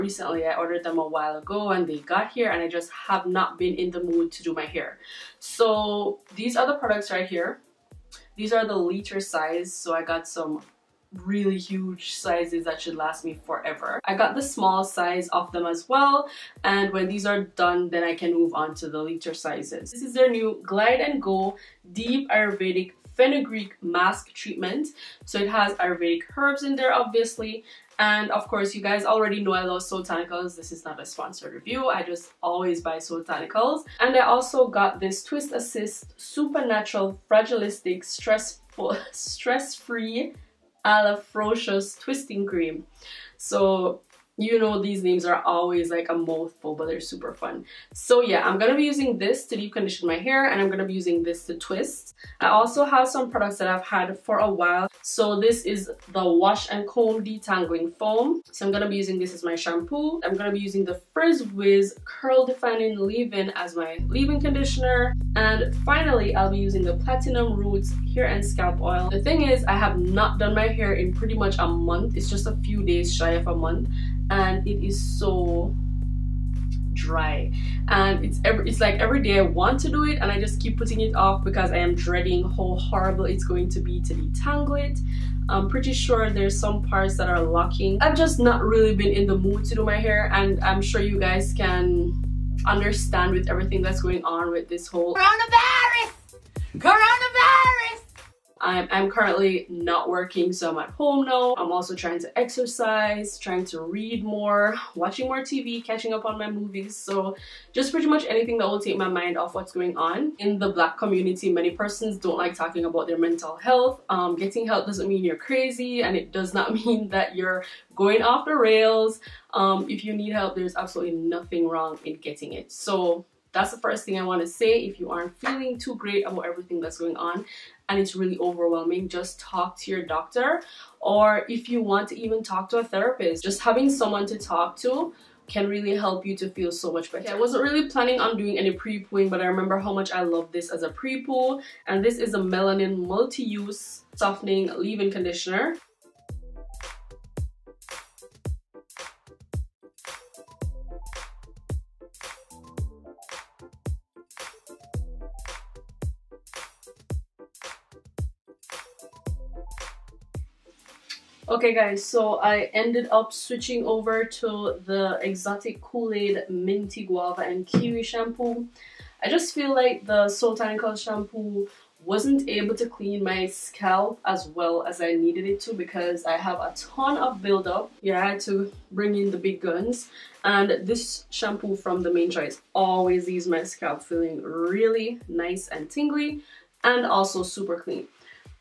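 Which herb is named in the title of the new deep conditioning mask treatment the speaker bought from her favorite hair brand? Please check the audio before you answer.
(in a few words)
Fenugreek.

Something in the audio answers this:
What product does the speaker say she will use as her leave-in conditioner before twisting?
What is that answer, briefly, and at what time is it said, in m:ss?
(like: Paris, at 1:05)
Frizz Wiz, at 1:01.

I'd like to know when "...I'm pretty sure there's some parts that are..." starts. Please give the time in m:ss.
1:25.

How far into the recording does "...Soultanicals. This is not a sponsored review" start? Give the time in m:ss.
0:29.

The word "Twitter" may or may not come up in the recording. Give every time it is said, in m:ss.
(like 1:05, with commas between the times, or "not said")
not said.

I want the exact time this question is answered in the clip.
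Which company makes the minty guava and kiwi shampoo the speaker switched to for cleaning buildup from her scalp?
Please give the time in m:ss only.
3:02.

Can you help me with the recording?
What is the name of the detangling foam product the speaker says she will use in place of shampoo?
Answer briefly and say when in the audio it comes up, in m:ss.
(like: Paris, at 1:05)
Wash and Comb, at 0:56.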